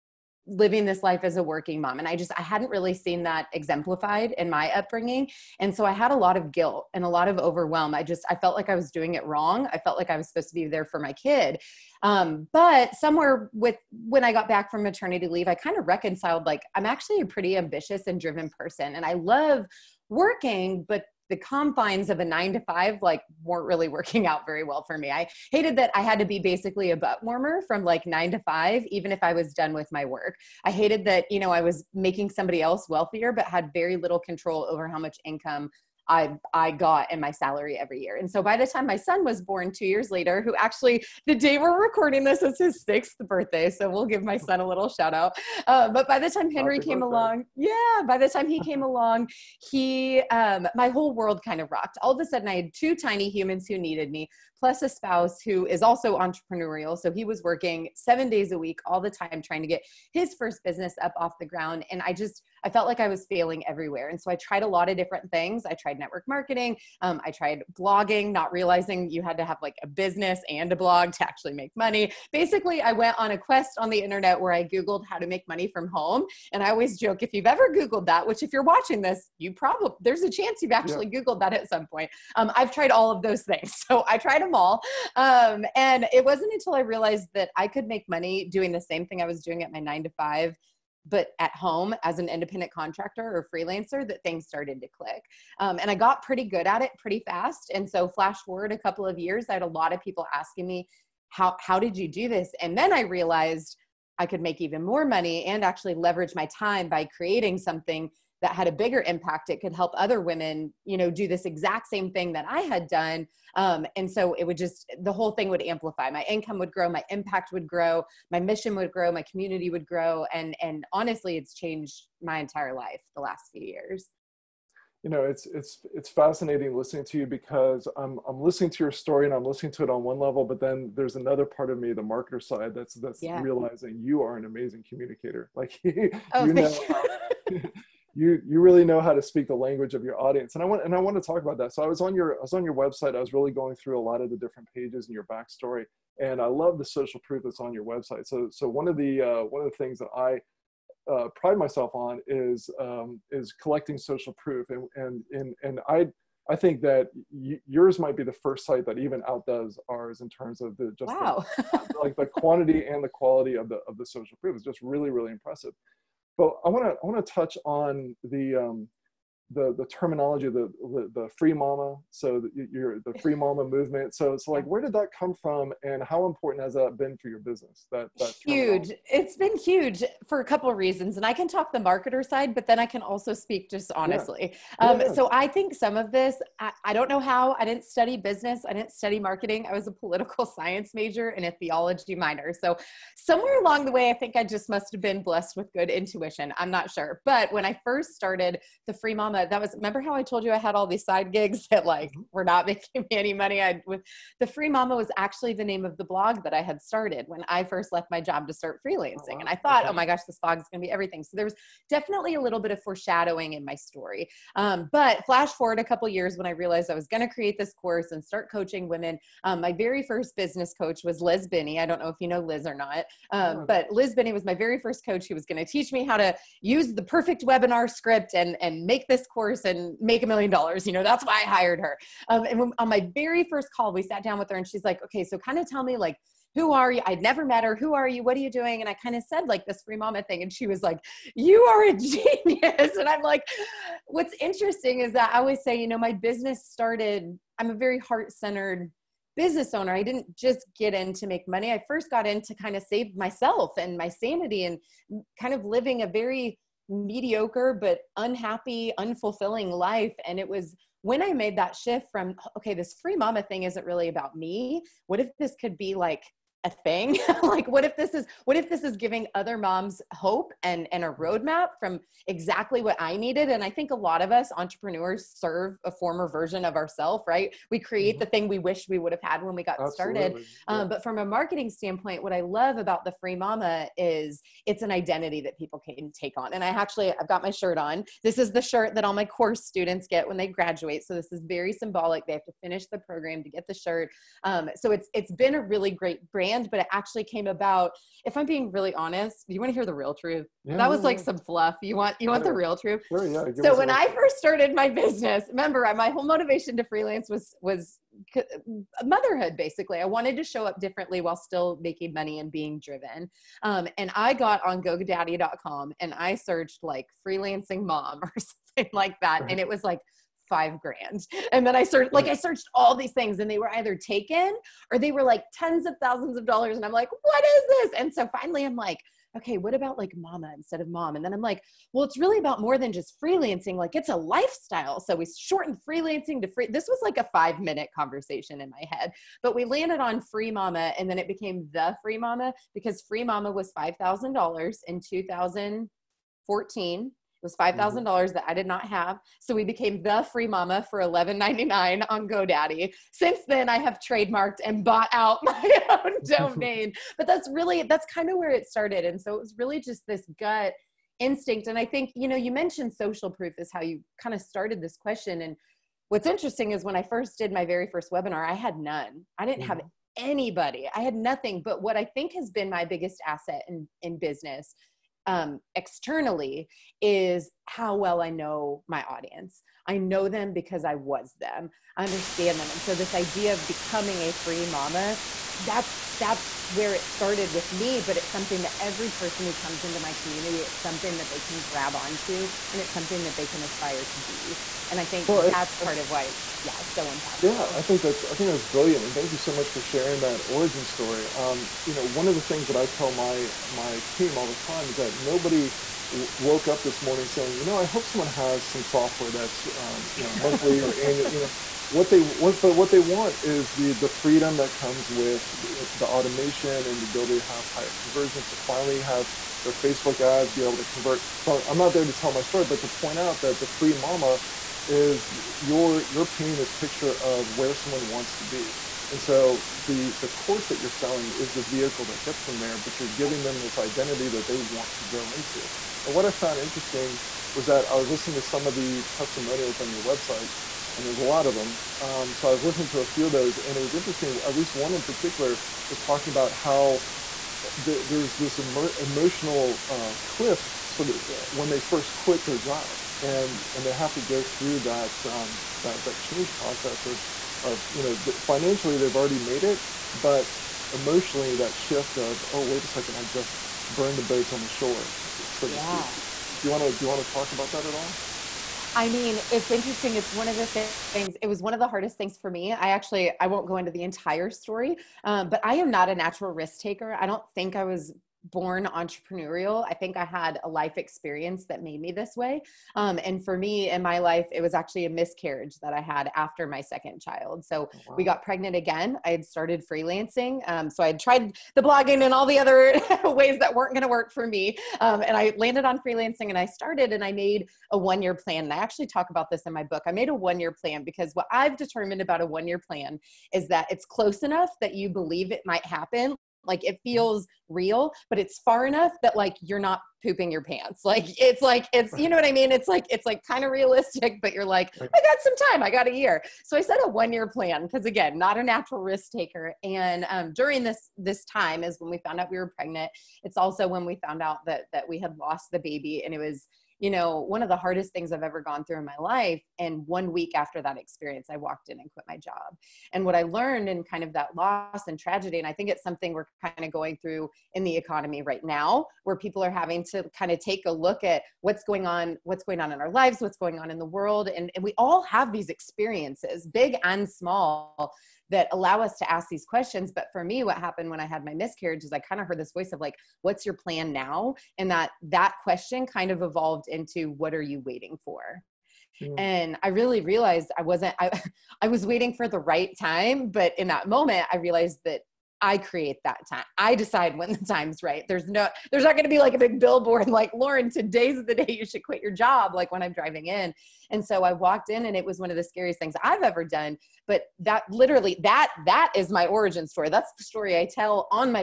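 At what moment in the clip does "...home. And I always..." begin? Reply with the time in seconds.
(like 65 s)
75 s.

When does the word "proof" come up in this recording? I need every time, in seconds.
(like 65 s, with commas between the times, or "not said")
147 s, 154 s, 164 s, 363 s.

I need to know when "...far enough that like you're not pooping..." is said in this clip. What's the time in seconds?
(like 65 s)
508 s.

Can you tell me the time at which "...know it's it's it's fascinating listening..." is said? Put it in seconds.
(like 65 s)
125 s.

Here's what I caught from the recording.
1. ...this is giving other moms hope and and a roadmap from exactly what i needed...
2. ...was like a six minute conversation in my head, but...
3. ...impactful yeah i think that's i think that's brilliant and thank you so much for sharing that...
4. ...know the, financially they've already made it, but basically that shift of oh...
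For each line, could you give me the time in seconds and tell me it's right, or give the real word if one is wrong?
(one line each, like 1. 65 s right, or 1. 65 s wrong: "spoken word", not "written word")
1. 268 s right
2. 336 s wrong: "five", not "six"
3. 397 s right
4. 458 s wrong: "emotionally", not "basically".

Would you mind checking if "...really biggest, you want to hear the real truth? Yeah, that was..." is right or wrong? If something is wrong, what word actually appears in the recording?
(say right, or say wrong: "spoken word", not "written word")
wrong: "honest", not "biggest".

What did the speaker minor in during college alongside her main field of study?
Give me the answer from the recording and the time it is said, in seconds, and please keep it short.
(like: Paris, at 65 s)
theology, at 191 s.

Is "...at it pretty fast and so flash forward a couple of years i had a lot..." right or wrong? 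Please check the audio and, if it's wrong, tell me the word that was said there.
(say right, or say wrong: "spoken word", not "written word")
right.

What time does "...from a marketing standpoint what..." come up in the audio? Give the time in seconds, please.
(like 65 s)
281 s.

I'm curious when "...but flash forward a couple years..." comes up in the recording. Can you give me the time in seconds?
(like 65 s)
214 s.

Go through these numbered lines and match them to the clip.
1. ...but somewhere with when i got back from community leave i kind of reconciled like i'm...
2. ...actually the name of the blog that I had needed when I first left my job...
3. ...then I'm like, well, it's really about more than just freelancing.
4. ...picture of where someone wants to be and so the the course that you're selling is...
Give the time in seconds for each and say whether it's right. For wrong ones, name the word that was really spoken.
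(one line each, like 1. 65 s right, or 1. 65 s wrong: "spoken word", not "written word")
1. 12 s wrong: "maternity", not "community"
2. 205 s wrong: "started", not "needed"
3. 331 s right
4. 426 s right.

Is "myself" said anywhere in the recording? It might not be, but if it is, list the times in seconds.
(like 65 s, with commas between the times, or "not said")
151 s, 253 s.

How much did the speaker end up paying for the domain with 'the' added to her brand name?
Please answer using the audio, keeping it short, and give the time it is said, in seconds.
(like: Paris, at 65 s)
$11.99, at 351 s.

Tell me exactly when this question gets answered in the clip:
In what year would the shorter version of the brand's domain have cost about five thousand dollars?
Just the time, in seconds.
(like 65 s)
345 s.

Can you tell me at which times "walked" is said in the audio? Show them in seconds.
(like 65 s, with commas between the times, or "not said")
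531 s, 574 s.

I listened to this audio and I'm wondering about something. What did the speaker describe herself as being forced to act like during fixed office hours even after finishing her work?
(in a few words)
butt warmer.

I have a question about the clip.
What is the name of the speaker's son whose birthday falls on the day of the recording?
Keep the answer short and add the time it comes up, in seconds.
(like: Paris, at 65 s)
Henry, at 46 s.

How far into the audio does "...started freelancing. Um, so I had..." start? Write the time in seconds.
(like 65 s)
489 s.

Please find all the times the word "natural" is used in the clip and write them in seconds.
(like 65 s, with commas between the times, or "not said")
476 s, 518 s.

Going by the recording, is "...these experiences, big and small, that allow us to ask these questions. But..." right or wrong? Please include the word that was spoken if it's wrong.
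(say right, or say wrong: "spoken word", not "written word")
right.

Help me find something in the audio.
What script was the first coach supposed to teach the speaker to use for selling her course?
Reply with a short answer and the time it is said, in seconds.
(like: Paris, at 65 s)
perfect webinar script, at 227 s.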